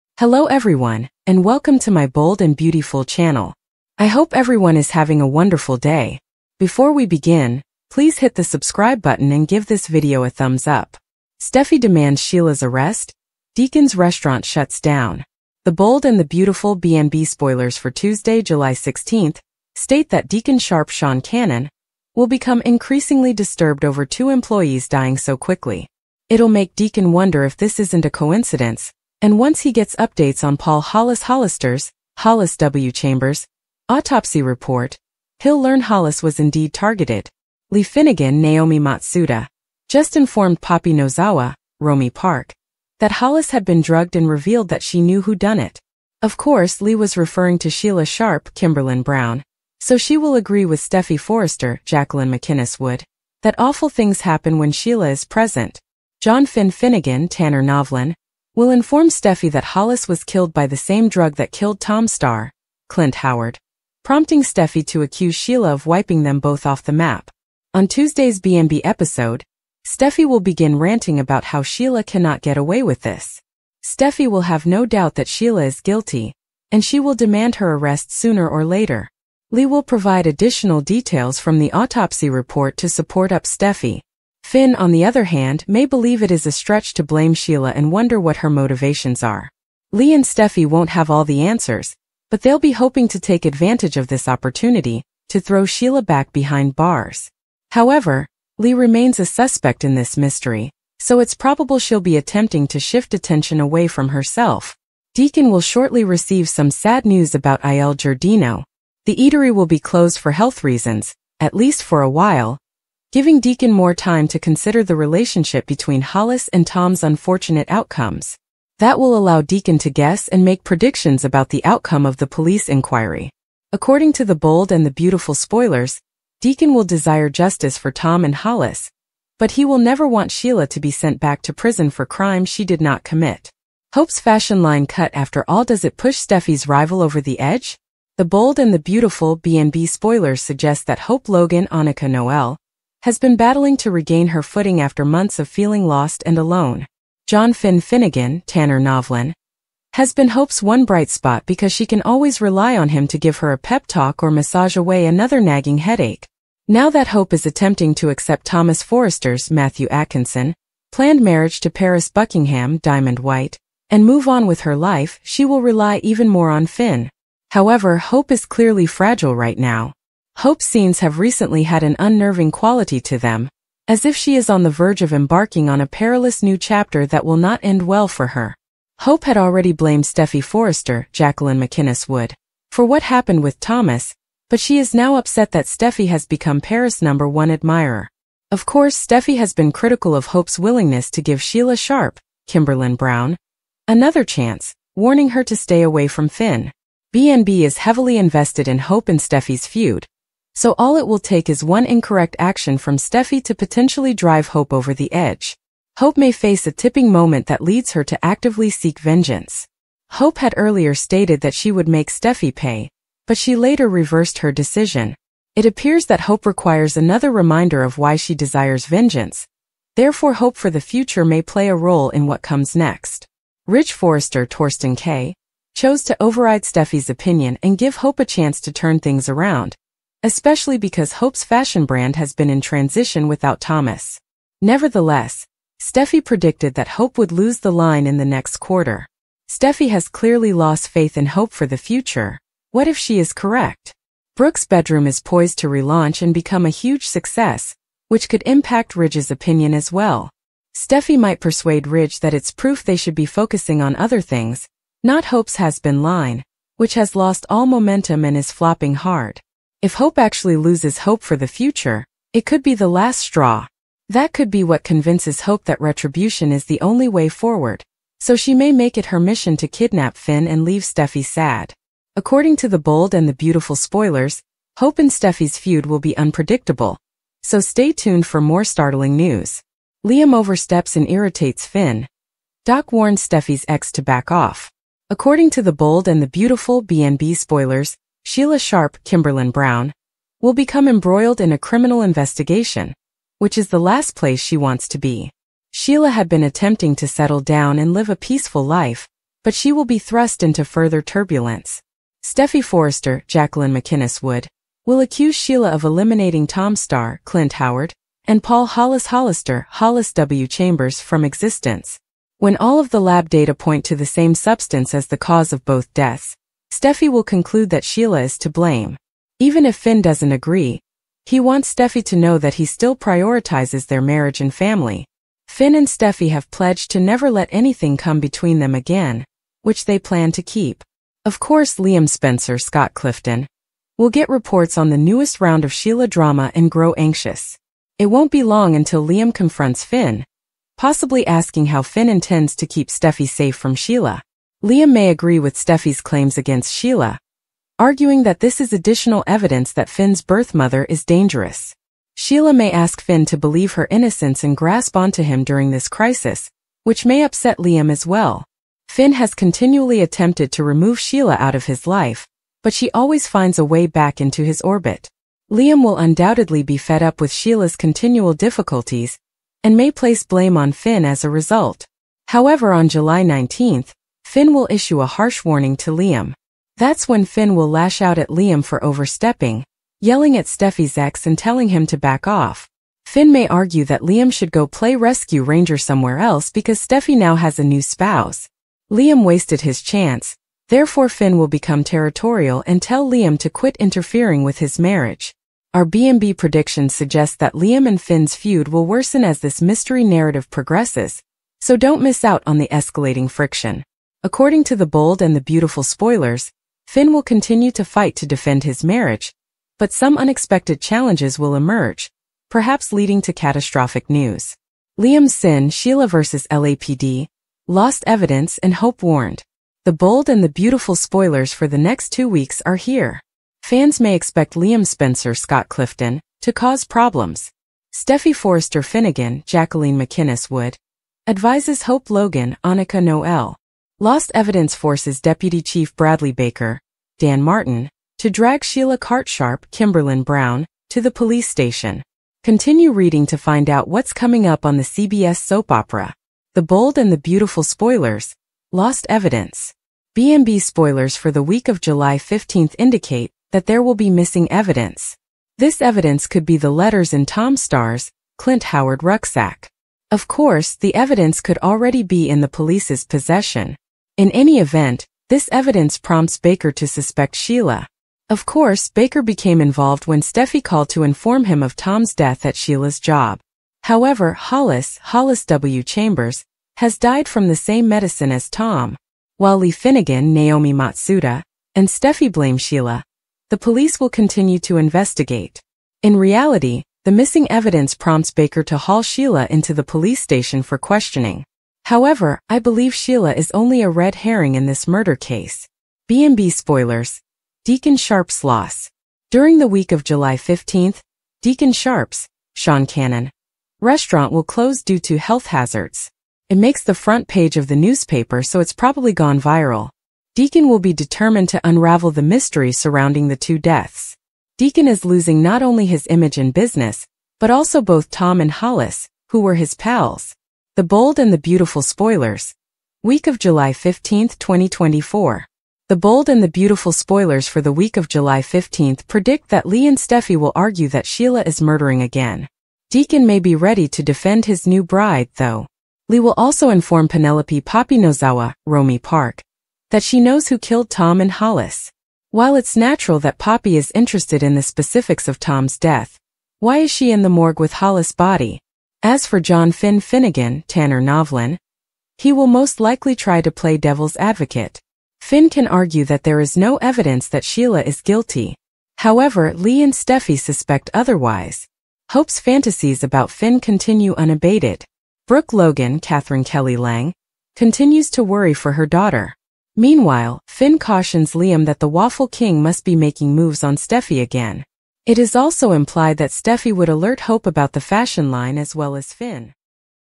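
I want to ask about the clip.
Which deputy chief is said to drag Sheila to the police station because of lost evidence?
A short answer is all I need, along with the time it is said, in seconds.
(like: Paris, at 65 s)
Bradley Baker, at 435 s.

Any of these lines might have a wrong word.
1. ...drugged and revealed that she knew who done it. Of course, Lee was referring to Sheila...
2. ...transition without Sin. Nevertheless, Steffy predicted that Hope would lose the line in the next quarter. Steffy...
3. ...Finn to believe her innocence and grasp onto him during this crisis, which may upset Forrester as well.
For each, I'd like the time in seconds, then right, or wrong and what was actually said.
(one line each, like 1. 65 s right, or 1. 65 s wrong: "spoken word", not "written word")
1. 43 s right
2. 232 s wrong: "Thomas", not "Sin"
3. 353 s wrong: "Liam", not "Forrester".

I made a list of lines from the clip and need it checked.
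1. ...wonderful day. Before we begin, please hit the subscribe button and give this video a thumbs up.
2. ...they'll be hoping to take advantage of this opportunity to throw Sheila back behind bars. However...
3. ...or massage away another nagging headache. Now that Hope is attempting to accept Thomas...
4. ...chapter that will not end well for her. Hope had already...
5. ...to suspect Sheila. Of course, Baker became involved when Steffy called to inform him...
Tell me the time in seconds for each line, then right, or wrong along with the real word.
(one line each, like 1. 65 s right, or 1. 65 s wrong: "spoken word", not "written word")
1. 5 s right
2. 92 s right
3. 154 s right
4. 176 s right
5. 466 s right.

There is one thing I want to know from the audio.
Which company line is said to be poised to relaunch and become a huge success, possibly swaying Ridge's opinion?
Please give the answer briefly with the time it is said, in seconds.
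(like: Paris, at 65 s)
Brooke's bedroom, at 244 s.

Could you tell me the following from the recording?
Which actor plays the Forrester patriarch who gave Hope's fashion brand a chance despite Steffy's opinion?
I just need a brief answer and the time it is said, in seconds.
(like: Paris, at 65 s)
Thorsten Kaye, at 224 s.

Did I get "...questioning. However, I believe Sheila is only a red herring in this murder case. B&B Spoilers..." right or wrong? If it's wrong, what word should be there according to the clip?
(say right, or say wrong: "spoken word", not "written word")
right.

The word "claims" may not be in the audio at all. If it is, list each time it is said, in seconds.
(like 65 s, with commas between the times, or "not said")
346 s.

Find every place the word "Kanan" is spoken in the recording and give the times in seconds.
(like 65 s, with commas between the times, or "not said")
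21 s, 502 s.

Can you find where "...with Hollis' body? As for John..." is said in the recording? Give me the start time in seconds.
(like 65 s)
547 s.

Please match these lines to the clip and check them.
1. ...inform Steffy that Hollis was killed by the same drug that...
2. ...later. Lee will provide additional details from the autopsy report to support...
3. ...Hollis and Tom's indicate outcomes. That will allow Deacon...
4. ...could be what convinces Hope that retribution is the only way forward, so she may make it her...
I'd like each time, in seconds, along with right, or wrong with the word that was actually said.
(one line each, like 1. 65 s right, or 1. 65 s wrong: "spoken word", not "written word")
1. 58 s right
2. 78 s right
3. 116 s wrong: "unfortunate", not "indicate"
4. 264 s right.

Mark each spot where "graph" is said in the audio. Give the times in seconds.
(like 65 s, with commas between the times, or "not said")
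not said.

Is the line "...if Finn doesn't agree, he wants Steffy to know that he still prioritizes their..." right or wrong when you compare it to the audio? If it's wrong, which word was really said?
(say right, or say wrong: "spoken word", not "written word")
right.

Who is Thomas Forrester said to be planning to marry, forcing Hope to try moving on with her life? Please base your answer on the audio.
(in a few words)
Paris Buckingham.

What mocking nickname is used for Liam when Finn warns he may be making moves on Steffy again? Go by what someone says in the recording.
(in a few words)
the Waffle King.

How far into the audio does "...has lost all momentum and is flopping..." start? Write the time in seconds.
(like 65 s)
256 s.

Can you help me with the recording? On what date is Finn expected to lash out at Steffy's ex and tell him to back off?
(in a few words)
July 19th.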